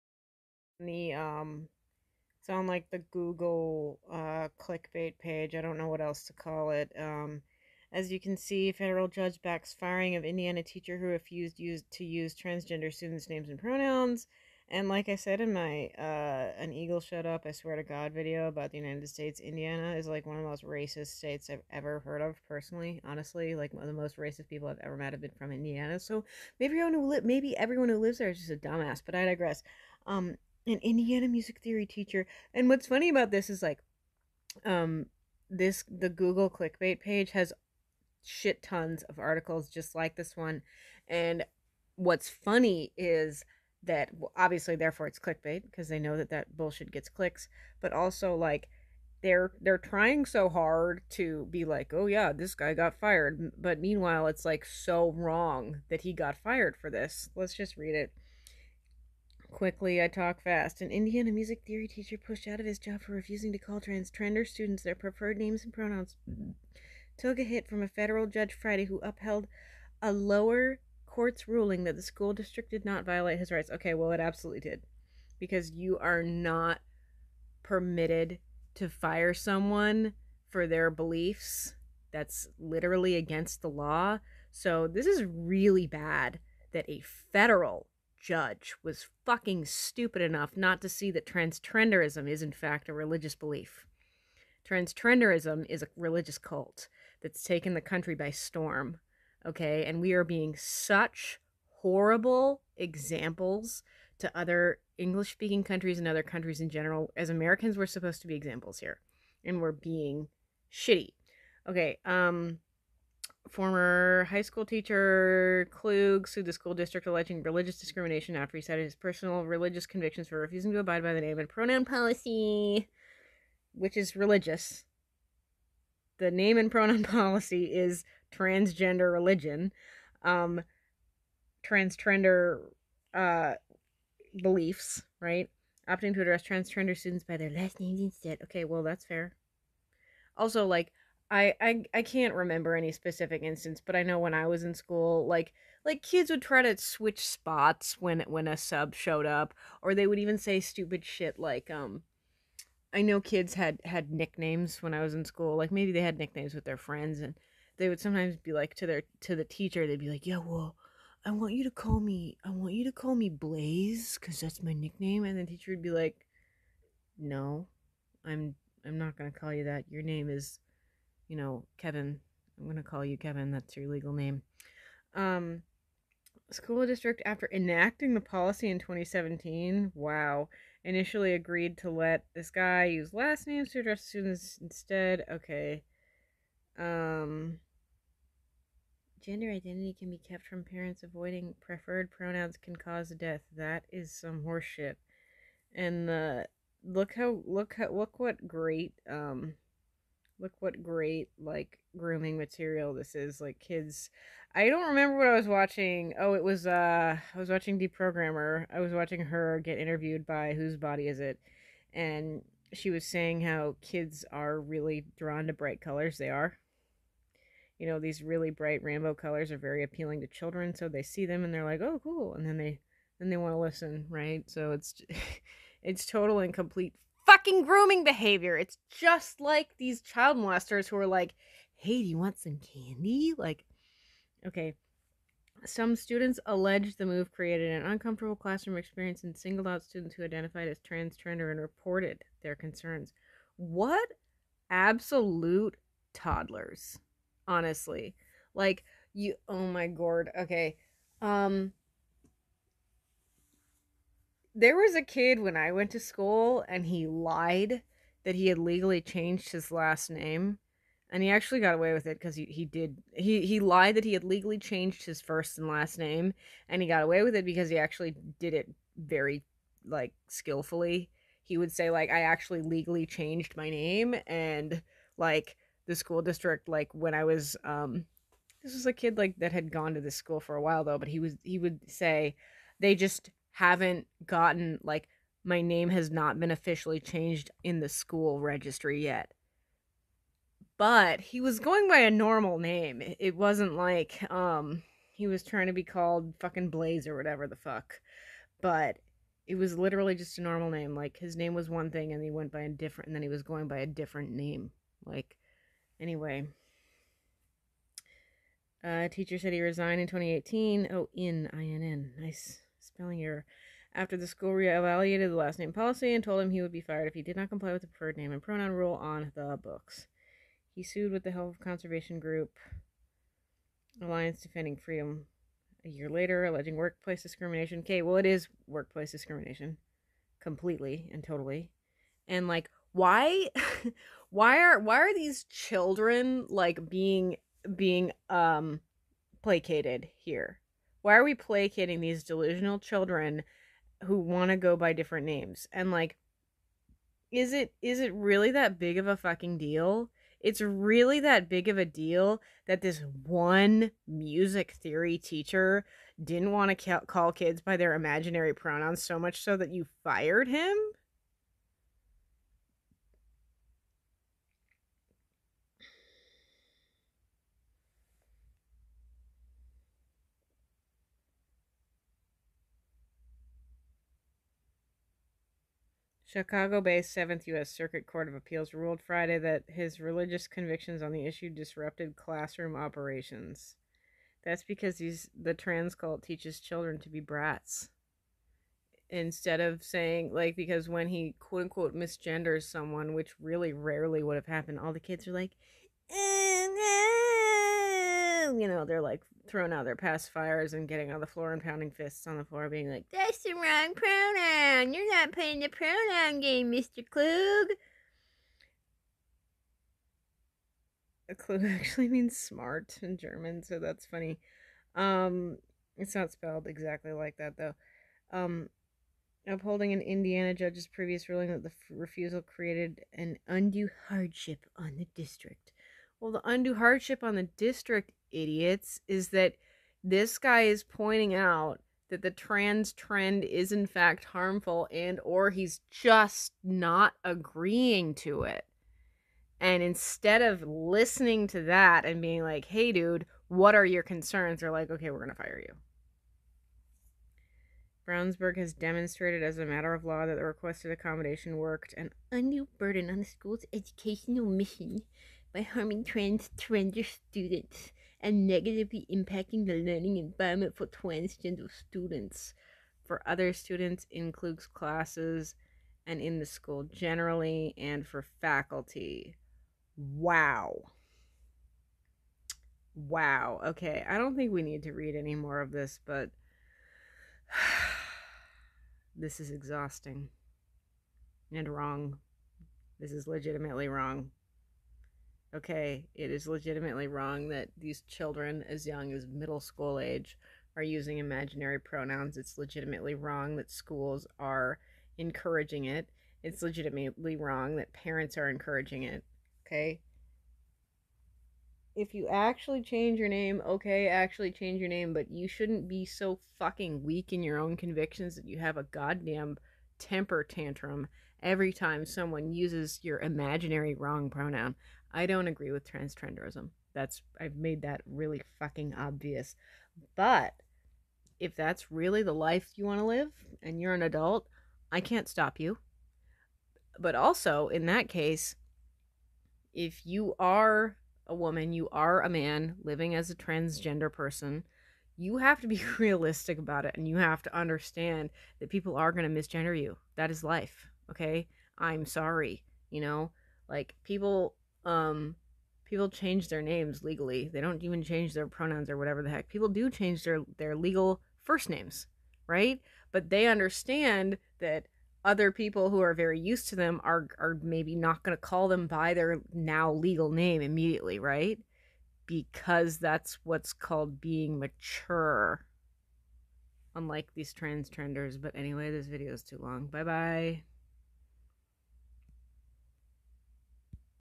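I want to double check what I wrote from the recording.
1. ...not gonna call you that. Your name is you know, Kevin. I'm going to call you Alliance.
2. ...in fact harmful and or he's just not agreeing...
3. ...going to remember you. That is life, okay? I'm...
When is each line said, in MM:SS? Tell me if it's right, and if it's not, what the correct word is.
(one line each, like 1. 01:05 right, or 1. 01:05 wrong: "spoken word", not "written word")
1. 02:48 wrong: "Kevin", not "Alliance"
2. 07:13 right
3. 08:59 wrong: "misgender", not "remember".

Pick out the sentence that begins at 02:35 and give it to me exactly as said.
Like maybe they had nicknames with their friends, and they would sometimes be like to their to the teacher.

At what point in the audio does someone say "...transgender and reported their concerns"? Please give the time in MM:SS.
04:00.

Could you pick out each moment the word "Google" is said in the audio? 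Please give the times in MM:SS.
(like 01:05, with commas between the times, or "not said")
00:03, 00:36.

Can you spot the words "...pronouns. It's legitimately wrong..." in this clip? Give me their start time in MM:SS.
08:11.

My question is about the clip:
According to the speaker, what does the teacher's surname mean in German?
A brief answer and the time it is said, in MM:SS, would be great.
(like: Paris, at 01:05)
smart, at 06:52.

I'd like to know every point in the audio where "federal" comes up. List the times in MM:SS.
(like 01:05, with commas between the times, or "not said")
00:08, 01:07, 01:27.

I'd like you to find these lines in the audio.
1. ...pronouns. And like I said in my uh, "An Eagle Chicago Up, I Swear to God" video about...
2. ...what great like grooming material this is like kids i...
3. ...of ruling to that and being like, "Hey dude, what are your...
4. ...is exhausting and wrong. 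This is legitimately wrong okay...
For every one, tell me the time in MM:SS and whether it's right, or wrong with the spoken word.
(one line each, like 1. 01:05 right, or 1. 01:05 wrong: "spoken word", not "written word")
1. 00:13 wrong: "Shut", not "Chicago"
2. 03:20 right
3. 07:20 wrong: "listening", not "ruling"
4. 07:59 right.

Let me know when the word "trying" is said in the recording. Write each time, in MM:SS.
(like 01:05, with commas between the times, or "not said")
00:49, 04:55.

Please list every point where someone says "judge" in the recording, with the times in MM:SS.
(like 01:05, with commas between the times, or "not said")
00:09, 01:08, 01:28, 07:00.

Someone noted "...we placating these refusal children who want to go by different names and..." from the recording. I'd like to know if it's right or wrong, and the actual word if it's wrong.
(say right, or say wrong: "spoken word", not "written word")
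wrong: "delusional", not "refusal".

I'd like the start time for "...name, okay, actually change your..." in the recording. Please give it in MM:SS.
08:23.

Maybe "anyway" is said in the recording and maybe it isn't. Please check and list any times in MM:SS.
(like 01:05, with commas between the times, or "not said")
05:05, 09:28.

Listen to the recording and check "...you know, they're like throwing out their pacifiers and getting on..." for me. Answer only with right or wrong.
right.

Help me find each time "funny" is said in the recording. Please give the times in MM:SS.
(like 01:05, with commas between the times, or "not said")
00:32, 00:42, 06:54.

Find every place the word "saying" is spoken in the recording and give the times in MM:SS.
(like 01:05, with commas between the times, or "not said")
03:33, 06:29.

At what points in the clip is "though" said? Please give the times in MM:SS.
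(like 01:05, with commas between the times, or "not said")
04:40, 06:57.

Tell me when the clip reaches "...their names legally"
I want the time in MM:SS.
09:06.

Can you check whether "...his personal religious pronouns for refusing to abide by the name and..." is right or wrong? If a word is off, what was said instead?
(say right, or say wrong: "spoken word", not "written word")
wrong: "convictions", not "pronouns".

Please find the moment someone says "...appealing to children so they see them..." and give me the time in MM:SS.
03:39.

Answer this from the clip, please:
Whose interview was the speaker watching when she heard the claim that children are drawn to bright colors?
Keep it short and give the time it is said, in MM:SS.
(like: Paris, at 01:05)
Deprogrammer, at 03:27.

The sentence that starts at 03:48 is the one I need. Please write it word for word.
It's just like these child molesters who are like, hey, do you want some candy?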